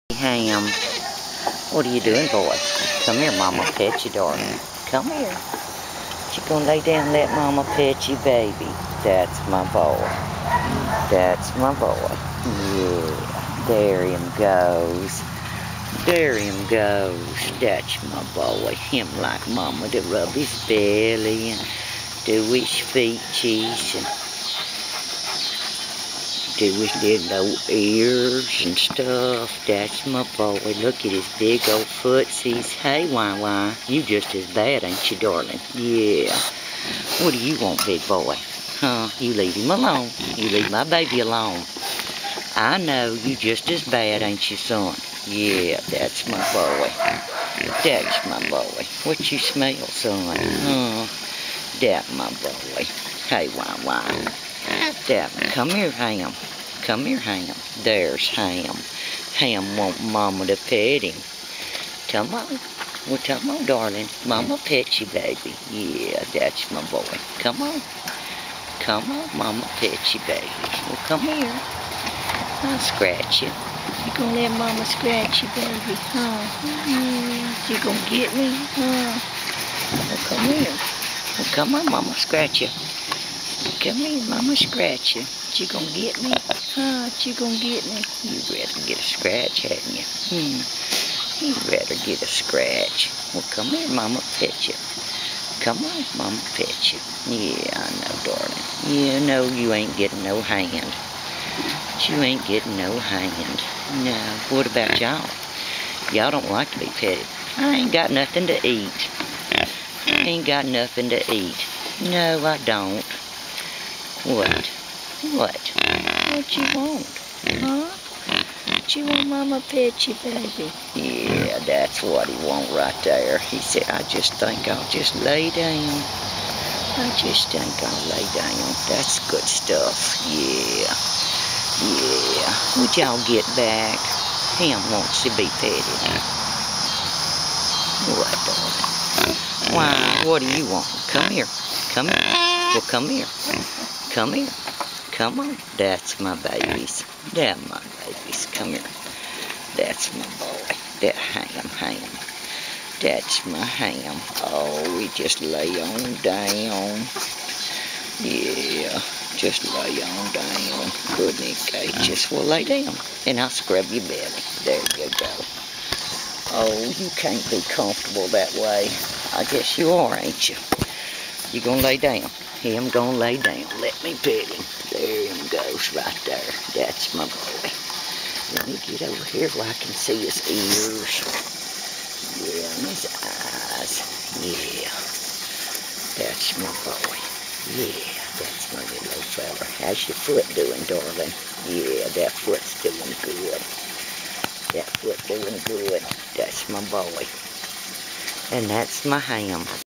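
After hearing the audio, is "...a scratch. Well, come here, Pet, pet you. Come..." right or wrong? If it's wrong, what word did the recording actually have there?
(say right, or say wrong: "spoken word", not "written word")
wrong: "Mama", not "Pet".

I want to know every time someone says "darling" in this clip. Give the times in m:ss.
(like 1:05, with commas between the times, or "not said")
0:04, 0:35, 1:03, 1:38, 2:19, 3:10.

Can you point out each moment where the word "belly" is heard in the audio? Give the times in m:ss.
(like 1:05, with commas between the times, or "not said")
0:20, 2:44.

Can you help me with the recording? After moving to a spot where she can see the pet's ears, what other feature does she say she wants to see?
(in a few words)
his eyes.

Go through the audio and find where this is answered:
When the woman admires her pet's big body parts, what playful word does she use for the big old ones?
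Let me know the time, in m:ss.
0:31.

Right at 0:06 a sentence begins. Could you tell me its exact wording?
She going to lay down let Mama Pet you, baby.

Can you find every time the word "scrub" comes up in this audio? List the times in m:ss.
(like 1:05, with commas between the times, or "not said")
2:43.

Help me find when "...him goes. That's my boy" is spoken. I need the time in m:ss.
0:16.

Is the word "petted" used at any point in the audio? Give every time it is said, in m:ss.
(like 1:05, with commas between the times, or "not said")
1:46, 2:15.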